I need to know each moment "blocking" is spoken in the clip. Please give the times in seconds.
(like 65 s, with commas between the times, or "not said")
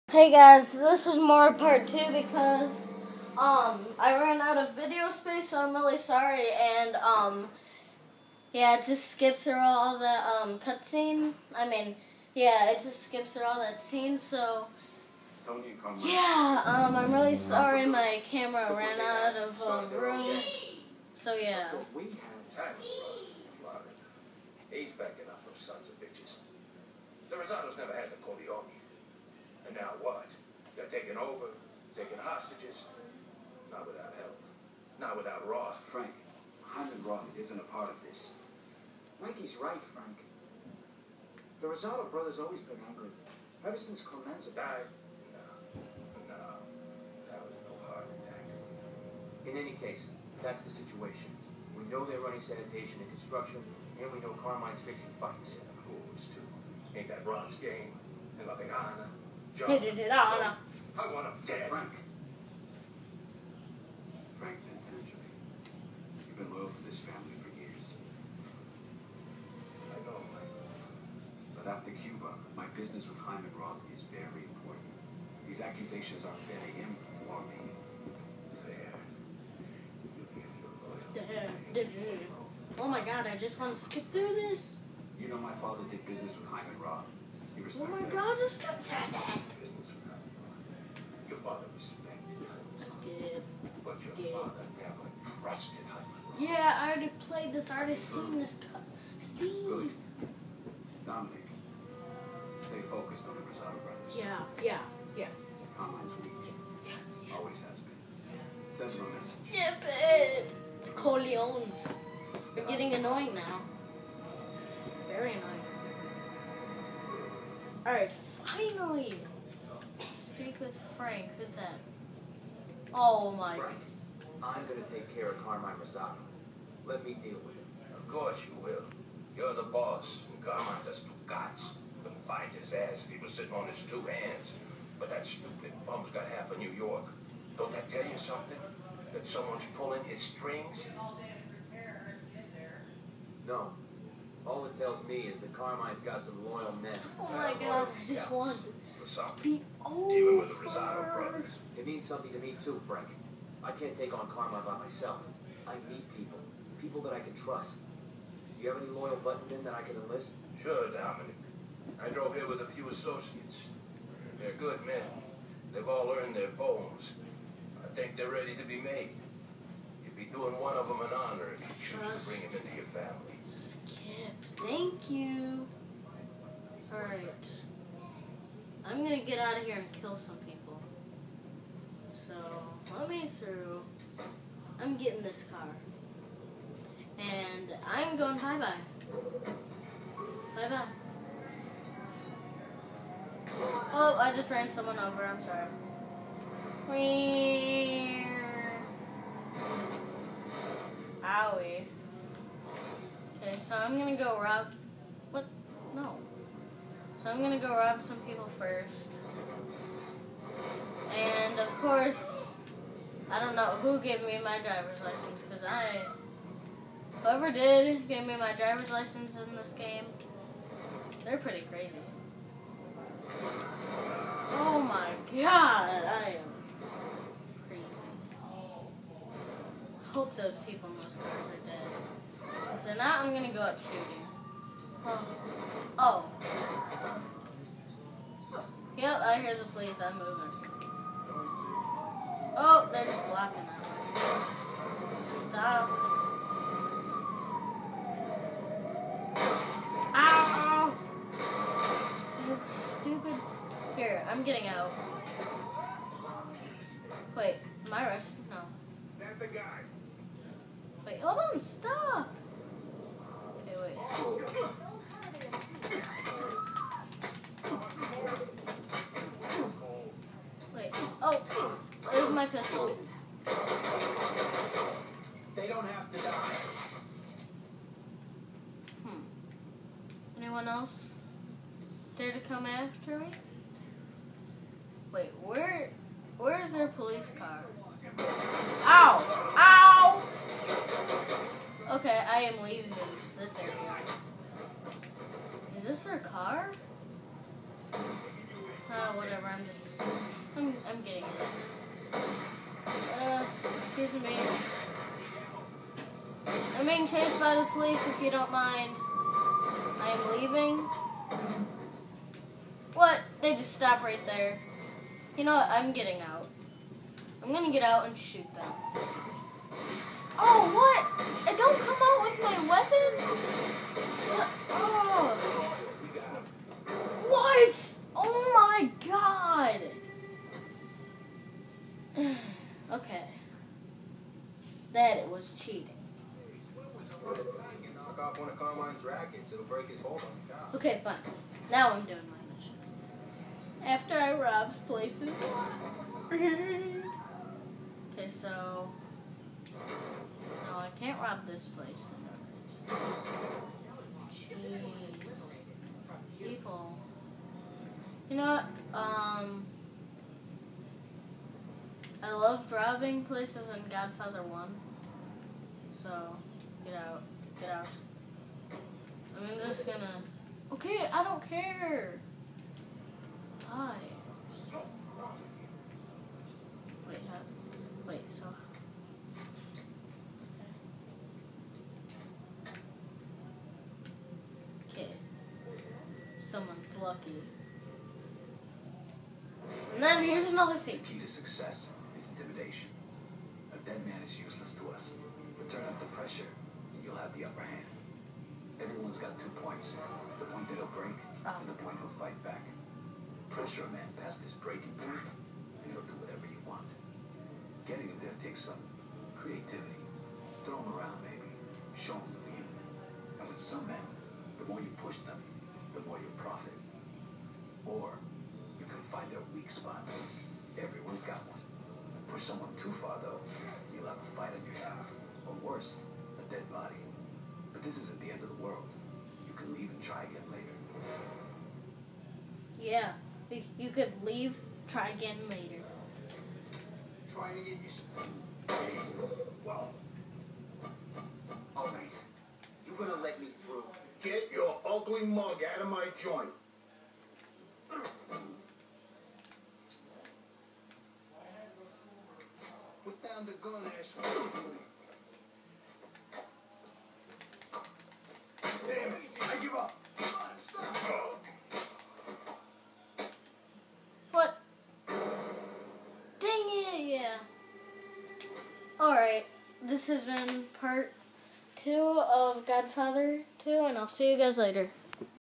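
243 s.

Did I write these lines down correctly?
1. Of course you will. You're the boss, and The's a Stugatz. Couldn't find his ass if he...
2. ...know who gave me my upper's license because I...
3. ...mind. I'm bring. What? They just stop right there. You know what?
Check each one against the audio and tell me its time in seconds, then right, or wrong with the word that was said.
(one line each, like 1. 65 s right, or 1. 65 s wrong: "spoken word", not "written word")
1. 127 s wrong: "Carmine", not "The"
2. 213 s wrong: "driver", not "upper"
3. 308 s wrong: "leaving", not "bring".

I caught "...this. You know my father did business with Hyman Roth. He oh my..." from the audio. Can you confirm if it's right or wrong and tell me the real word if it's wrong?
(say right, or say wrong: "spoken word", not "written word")
right.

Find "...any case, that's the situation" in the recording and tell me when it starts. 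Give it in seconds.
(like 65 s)
49 s.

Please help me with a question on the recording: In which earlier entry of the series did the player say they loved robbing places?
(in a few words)
Godfather 1.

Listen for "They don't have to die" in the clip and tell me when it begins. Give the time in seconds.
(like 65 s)
275 s.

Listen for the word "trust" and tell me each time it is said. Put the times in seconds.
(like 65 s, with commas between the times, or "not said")
157 s, 172 s.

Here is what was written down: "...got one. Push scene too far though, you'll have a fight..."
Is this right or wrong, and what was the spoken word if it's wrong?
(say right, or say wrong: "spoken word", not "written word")
wrong: "someone", not "scene".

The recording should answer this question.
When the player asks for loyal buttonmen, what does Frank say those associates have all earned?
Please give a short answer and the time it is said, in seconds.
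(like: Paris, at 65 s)
their bones, at 166 s.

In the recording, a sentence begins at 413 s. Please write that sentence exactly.
And with some men, the more you push them, the more you profit.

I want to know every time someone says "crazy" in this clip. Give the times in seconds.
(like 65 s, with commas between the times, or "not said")
221 s, 227 s.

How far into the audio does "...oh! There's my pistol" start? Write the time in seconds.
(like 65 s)
271 s.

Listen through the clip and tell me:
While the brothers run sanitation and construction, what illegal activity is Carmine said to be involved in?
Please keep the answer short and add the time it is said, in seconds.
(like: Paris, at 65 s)
fixing fights, at 54 s.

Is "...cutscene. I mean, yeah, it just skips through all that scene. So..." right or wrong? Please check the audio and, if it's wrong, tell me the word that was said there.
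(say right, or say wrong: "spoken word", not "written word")
right.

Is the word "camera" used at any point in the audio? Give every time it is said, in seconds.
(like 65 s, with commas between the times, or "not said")
18 s.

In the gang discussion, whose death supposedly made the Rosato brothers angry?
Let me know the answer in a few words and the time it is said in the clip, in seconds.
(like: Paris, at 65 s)
Clemenza, at 44 s.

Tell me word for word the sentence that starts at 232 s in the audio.
If they're not, I'm gonna go up shooting.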